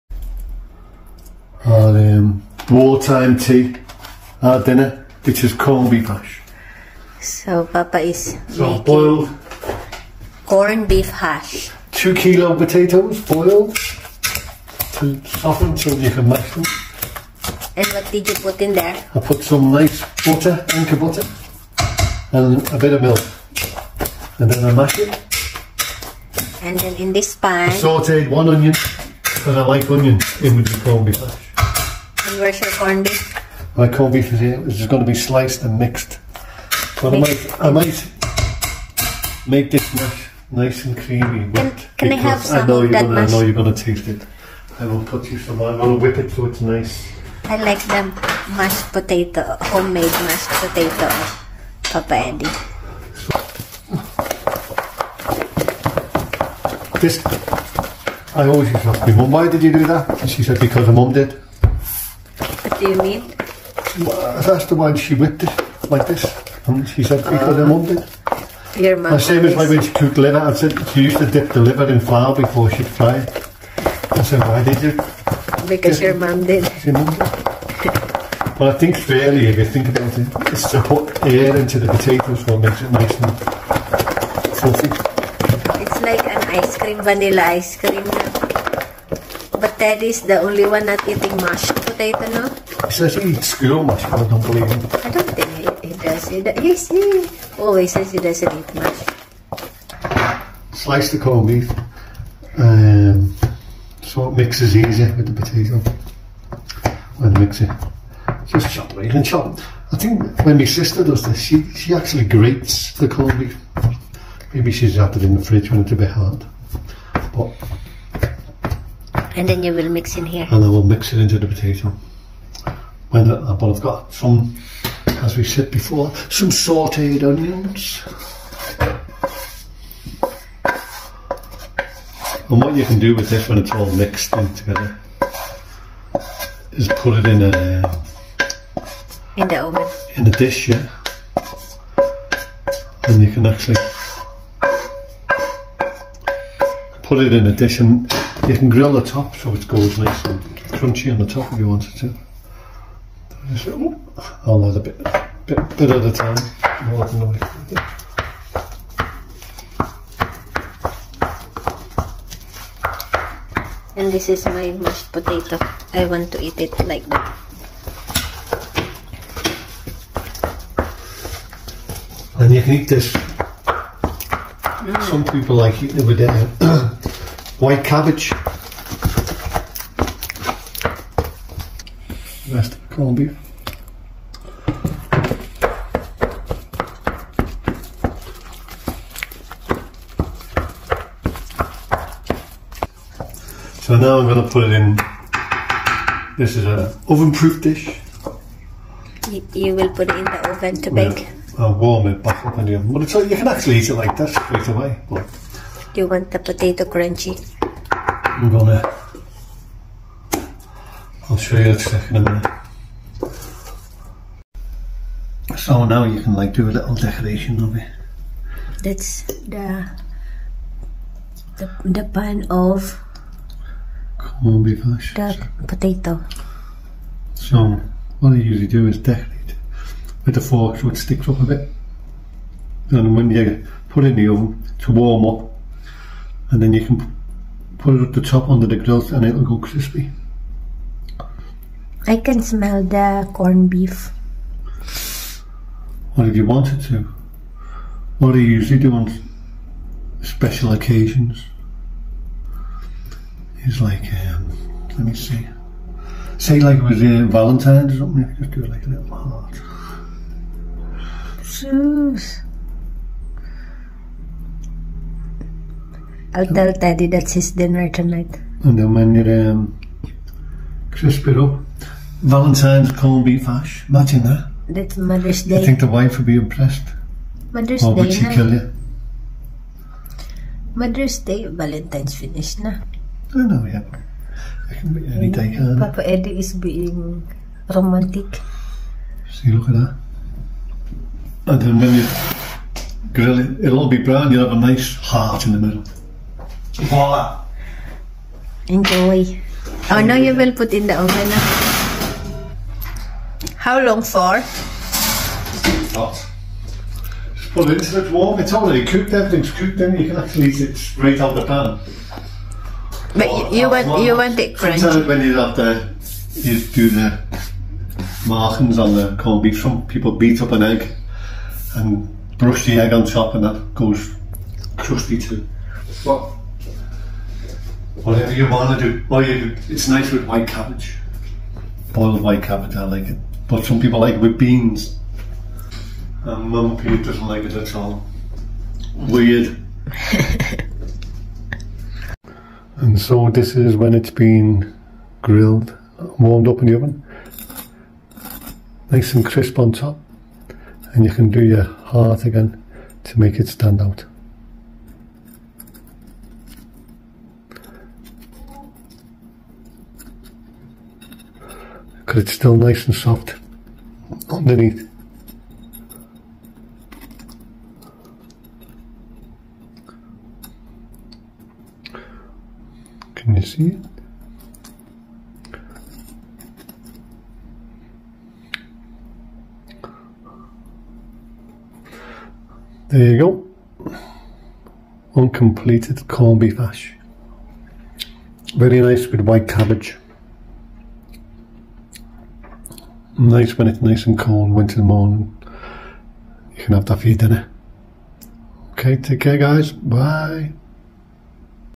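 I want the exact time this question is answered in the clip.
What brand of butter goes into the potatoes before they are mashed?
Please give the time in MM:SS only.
00:20.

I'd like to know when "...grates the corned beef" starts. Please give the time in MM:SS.
01:52.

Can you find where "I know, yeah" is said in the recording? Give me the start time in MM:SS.
04:43.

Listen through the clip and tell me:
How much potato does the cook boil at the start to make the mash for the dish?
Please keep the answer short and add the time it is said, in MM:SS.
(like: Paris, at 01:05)
2 kilo, at 00:11.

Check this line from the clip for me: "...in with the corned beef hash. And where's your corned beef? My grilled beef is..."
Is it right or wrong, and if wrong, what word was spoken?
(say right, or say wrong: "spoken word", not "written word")
wrong: "corned", not "grilled".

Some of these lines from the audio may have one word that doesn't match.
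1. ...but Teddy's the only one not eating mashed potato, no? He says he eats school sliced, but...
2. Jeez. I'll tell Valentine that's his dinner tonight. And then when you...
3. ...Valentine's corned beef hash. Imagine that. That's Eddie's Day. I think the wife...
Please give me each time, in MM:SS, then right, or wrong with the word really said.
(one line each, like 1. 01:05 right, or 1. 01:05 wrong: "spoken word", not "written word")
1. 01:29 wrong: "mashed", not "sliced"
2. 04:21 wrong: "Teddy", not "Valentine"
3. 04:32 wrong: "Mother", not "Eddie".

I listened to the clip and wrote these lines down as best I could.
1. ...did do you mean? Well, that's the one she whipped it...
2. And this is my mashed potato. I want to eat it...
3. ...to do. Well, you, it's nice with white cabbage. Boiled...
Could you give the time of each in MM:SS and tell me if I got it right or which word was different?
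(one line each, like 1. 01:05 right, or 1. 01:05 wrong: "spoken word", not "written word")
1. 01:01 right
2. 02:43 right
3. 05:28 right.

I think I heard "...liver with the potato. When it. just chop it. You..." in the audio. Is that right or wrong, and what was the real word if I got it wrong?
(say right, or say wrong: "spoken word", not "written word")
wrong: "easier", not "liver".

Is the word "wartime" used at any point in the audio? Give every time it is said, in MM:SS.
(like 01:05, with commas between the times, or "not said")
00:02.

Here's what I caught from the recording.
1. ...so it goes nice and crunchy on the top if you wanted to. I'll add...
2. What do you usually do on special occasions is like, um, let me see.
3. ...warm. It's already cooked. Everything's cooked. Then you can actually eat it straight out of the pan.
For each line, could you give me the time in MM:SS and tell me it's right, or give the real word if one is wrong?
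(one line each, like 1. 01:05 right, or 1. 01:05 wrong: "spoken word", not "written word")
1. 02:29 right
2. 04:08 right
3. 05:08 right.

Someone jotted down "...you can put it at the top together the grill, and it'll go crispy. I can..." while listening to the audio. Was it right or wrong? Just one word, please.
wrong.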